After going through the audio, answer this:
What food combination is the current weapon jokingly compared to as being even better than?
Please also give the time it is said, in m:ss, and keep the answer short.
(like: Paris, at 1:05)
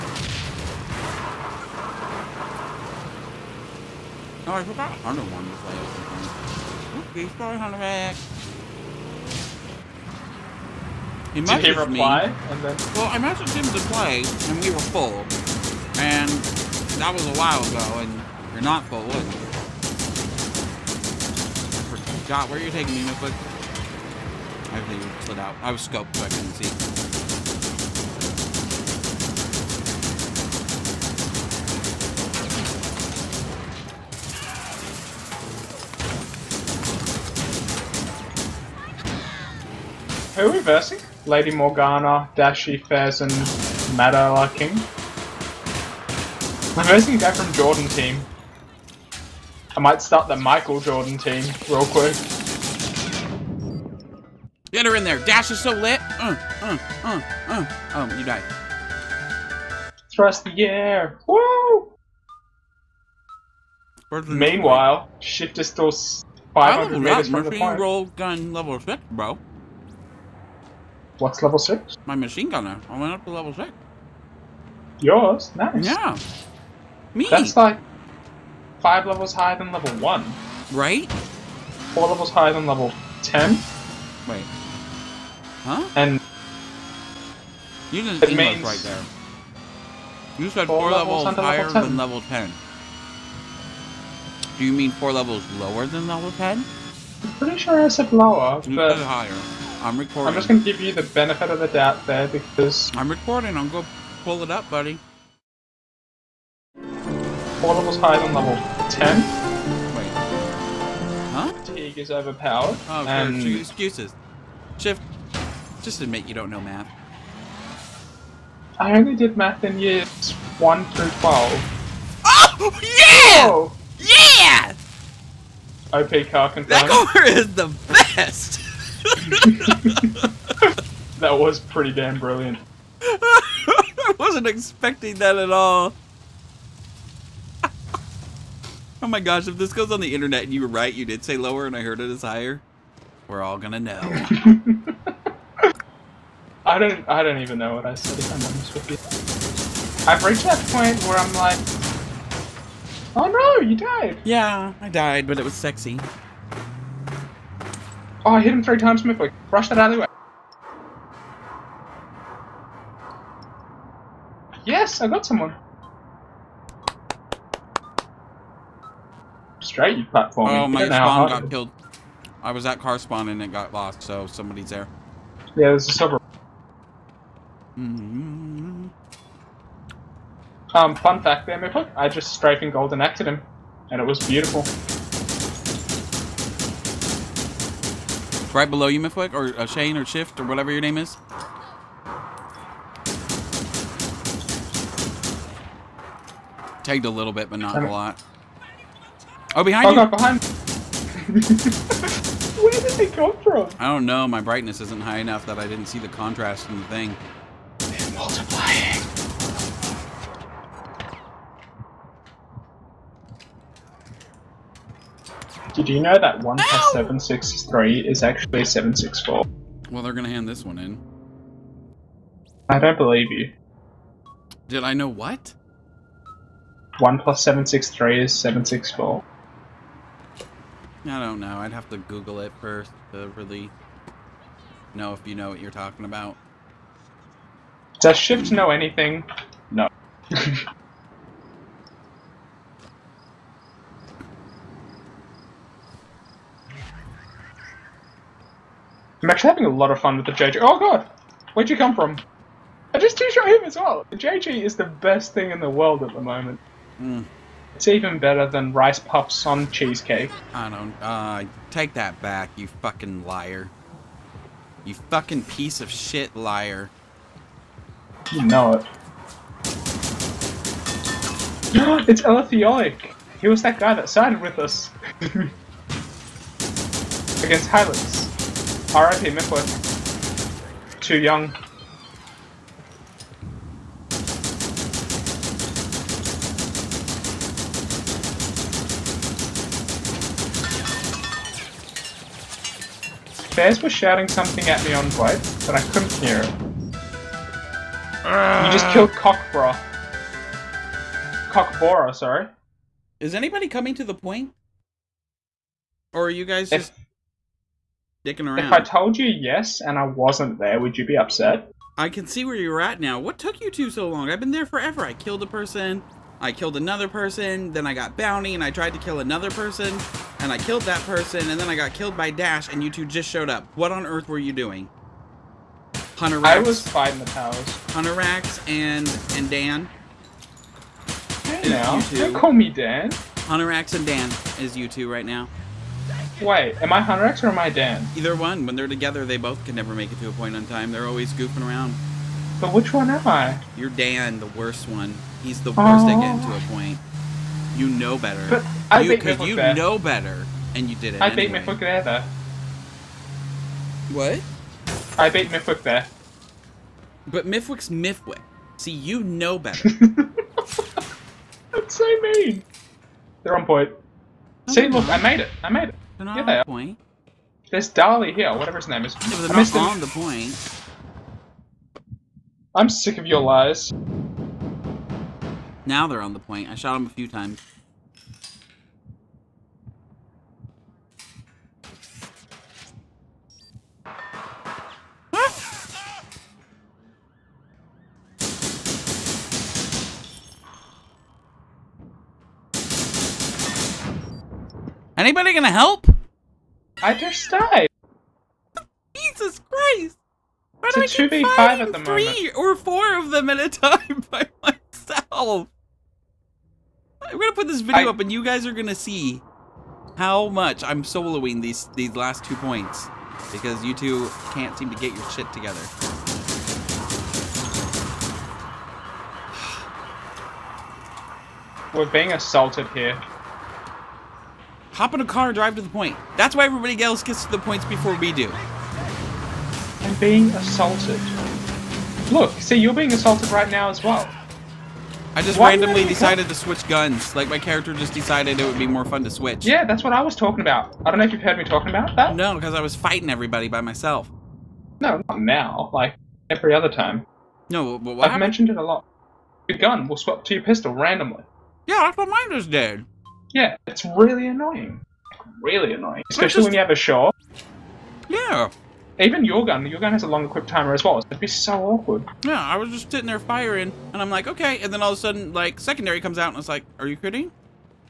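Rice Puffs on Cheesecake, at 4:18.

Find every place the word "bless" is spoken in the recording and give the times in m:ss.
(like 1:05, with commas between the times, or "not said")
not said.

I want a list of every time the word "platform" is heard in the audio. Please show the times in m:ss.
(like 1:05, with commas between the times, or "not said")
2:50.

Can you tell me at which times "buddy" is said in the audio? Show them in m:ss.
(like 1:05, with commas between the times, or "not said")
1:44.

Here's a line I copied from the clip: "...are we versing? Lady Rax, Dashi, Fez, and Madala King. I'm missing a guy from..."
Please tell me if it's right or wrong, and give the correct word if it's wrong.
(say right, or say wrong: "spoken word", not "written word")
wrong: "Morgana", not "Rax".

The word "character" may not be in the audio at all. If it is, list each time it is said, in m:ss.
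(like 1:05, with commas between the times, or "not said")
7:17.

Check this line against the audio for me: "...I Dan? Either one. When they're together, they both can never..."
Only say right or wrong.
right.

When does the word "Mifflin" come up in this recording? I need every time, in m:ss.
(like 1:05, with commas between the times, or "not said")
4:39.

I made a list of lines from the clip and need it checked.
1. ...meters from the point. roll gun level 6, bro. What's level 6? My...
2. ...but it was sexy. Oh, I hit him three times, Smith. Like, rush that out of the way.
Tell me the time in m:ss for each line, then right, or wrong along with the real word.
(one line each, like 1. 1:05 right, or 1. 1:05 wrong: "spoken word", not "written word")
1. 1:06 right
2. 2:35 right.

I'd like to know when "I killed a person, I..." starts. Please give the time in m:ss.
5:15.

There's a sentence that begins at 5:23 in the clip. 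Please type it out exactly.
What on earth were you doing?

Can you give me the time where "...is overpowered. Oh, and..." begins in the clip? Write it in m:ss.
1:51.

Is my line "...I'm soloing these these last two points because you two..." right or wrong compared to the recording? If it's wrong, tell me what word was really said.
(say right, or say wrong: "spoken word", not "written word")
right.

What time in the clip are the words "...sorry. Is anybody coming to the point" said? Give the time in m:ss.
5:02.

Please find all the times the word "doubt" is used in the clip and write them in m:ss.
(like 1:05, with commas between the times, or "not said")
1:41.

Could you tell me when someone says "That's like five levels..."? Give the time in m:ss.
1:17.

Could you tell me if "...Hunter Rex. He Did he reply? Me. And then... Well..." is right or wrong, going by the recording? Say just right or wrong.
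right.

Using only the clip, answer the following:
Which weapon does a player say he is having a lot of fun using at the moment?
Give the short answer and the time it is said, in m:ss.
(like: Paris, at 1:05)
JG, at 4:10.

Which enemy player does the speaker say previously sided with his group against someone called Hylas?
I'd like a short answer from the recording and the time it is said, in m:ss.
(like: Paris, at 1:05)
Elithioic, at 4:32.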